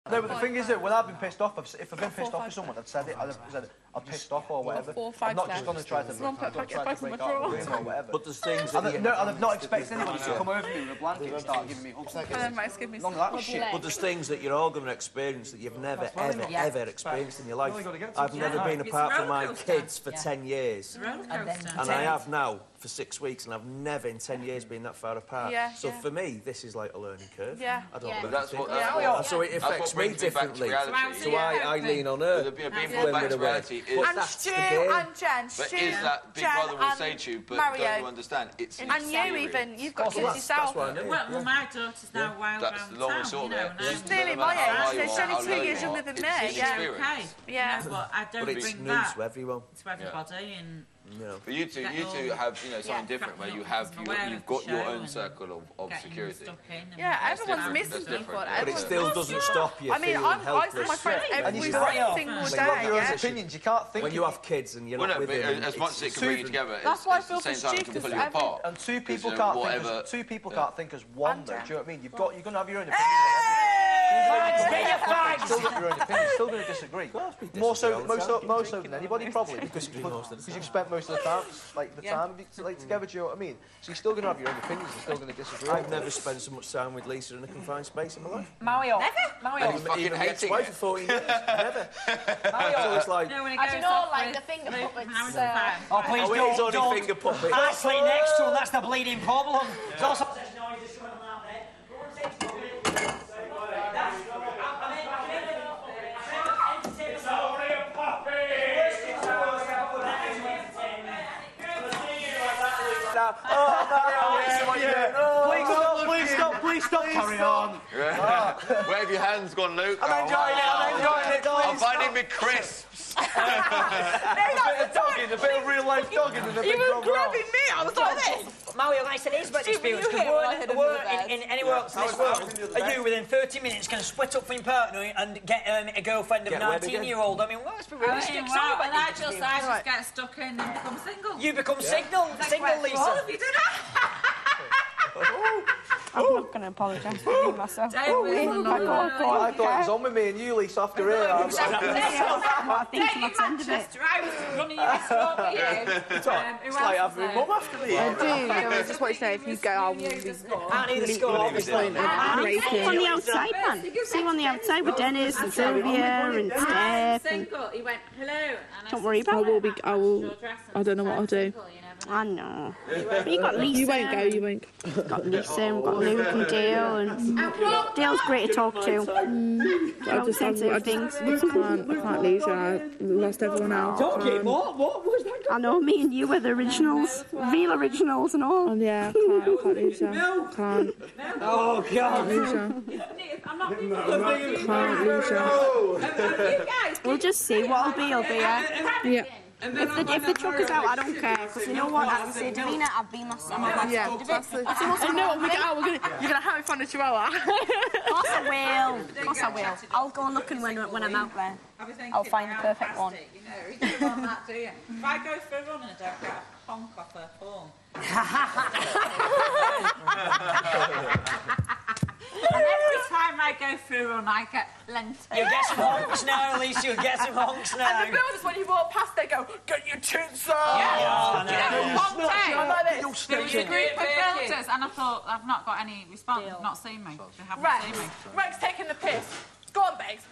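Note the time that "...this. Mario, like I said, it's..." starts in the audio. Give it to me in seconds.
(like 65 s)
128 s.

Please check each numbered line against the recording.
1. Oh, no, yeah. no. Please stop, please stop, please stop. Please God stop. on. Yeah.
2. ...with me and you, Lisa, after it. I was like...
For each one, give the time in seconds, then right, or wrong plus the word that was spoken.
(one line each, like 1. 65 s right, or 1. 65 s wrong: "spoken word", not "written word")
1. 113 s wrong: "Carry", not "God"
2. 150 s right.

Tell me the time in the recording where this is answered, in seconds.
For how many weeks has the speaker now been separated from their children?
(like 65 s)
22 s.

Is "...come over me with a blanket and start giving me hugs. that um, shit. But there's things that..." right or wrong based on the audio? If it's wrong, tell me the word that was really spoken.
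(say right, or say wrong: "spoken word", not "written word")
right.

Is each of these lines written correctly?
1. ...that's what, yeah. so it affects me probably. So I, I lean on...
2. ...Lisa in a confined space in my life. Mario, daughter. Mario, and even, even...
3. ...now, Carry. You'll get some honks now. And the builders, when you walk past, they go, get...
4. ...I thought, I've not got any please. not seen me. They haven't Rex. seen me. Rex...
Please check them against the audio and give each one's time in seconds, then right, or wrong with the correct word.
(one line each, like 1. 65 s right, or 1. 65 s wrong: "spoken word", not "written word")
1. 28 s wrong: "differently", not "probably"
2. 87 s wrong: "never", not "daughter"
3. 226 s wrong: "Elise", not "Carry"
4. 234 s wrong: "response", not "please".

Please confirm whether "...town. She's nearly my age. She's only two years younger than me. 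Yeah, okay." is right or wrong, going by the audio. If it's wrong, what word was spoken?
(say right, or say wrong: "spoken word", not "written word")
right.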